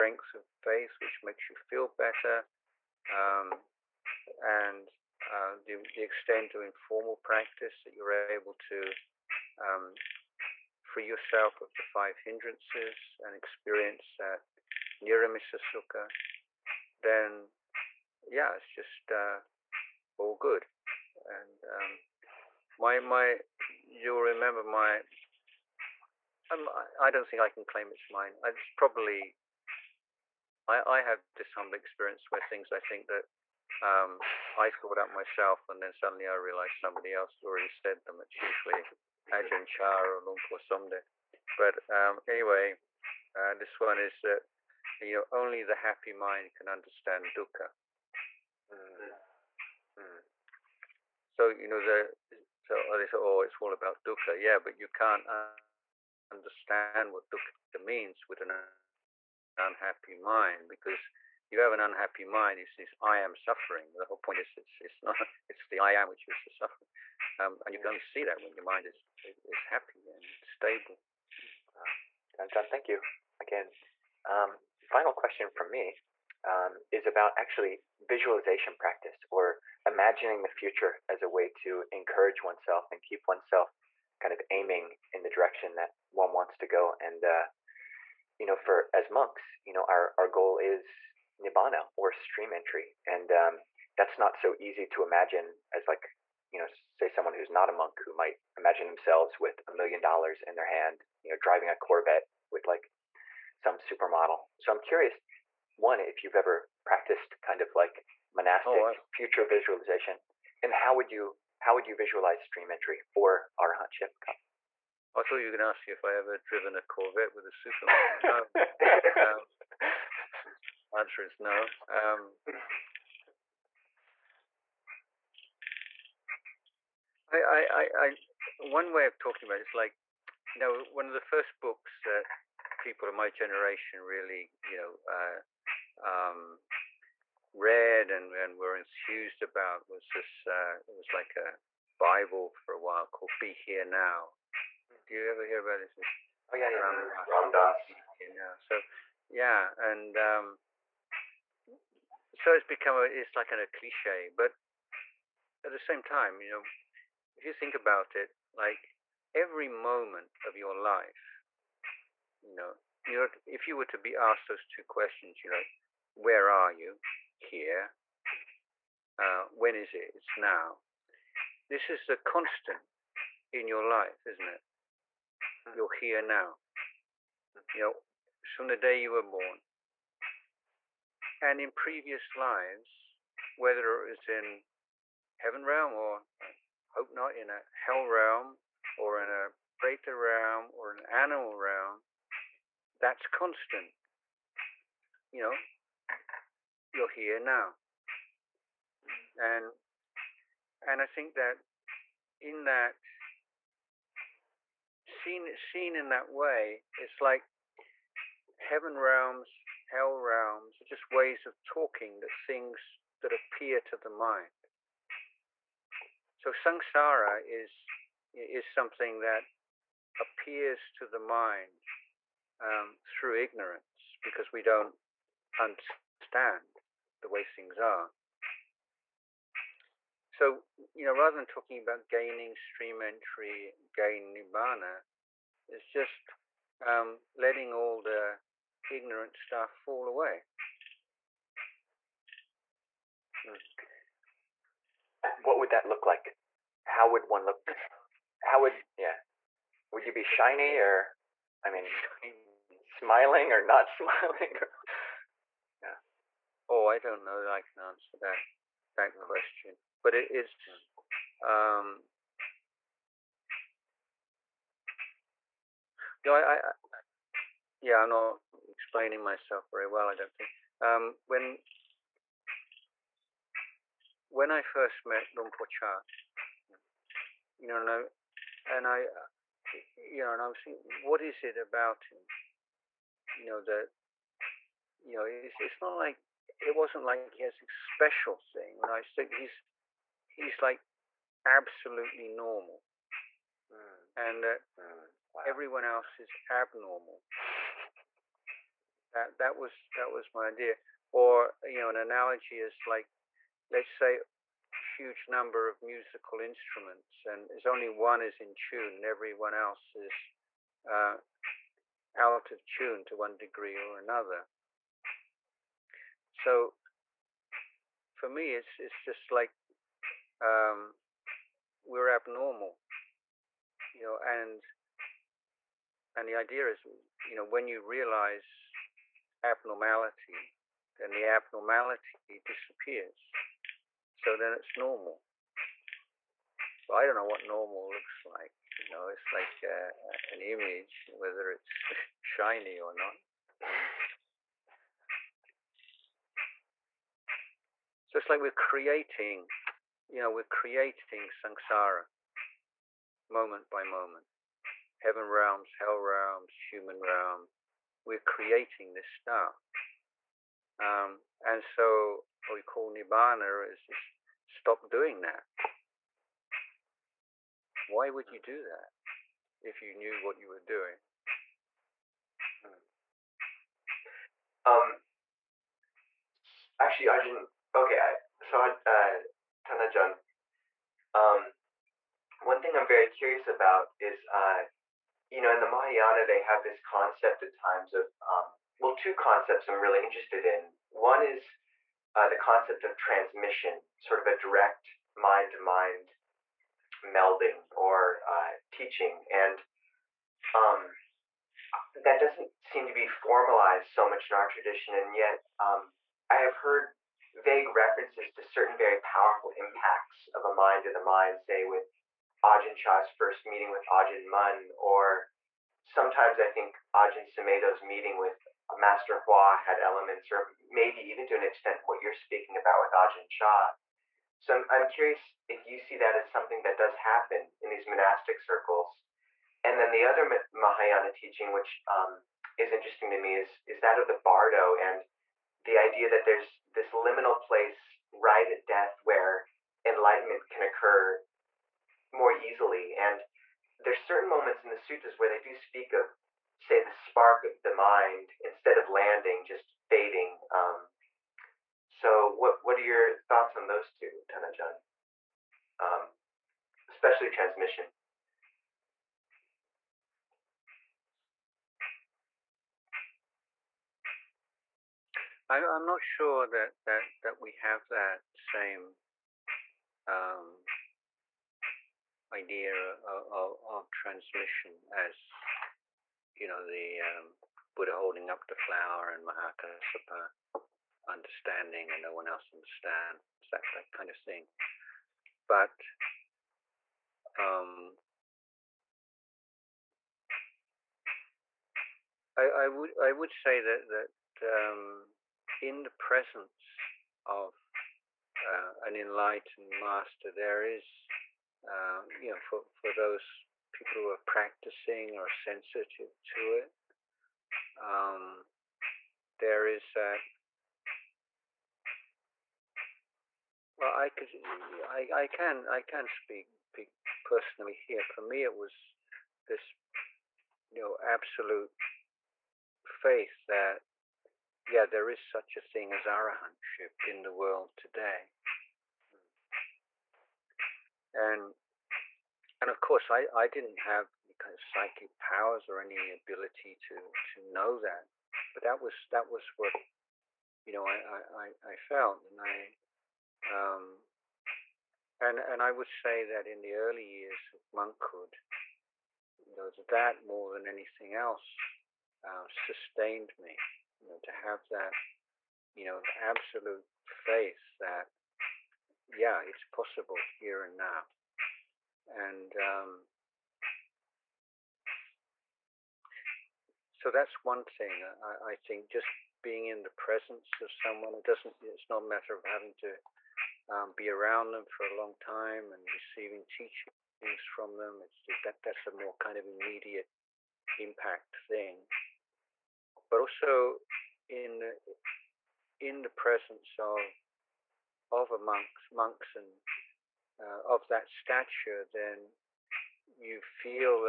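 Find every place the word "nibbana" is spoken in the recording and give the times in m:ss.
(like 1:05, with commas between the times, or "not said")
1:31, 3:54, 6:02.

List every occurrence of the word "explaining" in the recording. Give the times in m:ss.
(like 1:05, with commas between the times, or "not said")
4:28.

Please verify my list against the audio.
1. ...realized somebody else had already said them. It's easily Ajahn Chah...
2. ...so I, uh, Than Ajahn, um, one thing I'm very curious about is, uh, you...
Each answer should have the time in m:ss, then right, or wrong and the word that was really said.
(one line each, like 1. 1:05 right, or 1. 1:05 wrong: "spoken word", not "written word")
1. 0:36 wrong: "usually", not "easily"
2. 6:18 right.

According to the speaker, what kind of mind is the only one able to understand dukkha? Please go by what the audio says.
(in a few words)
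The happy mind.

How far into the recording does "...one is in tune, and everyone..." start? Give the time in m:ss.
5:07.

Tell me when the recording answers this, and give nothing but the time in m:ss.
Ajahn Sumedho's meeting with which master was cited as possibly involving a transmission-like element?
6:58.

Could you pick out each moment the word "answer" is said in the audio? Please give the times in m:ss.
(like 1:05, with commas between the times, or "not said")
2:00, 4:17.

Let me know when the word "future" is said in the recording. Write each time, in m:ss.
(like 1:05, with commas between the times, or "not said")
1:20, 1:49.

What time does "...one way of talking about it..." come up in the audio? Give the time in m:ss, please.
2:08.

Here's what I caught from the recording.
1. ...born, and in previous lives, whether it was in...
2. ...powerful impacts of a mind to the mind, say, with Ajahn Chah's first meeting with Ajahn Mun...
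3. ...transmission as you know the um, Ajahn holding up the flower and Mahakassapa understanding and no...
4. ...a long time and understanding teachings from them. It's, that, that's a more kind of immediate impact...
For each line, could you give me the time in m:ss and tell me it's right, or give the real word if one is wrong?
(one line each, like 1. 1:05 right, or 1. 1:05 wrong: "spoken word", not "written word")
1. 2:59 right
2. 6:48 right
3. 7:53 wrong: "Buddha", not "Ajahn"
4. 9:34 wrong: "receiving", not "understanding".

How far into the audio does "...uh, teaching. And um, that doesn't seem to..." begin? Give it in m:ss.
6:38.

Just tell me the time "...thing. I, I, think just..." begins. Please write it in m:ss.
9:27.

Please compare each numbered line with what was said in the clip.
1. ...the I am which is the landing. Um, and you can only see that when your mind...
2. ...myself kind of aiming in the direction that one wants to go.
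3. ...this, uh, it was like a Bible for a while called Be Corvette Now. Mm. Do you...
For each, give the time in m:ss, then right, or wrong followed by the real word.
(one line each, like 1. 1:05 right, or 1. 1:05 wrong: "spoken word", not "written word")
1. 1:05 wrong: "suffering", not "landing"
2. 1:23 wrong: "oneself", not "myself"
3. 2:20 wrong: "Here", not "Corvette".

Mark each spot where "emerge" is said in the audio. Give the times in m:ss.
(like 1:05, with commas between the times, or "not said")
not said.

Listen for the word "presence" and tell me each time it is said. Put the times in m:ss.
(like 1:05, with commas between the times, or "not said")
8:15, 9:29, 9:46.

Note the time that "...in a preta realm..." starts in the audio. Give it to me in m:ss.
3:09.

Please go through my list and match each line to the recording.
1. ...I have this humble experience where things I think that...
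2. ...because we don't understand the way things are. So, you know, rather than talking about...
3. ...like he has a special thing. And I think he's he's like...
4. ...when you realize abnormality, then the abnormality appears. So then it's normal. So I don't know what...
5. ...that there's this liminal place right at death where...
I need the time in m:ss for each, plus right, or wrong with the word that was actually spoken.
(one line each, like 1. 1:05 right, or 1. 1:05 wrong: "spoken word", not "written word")
1. 0:30 right
2. 3:44 right
3. 4:47 right
4. 5:27 wrong: "disappears", not "appears"
5. 7:16 right.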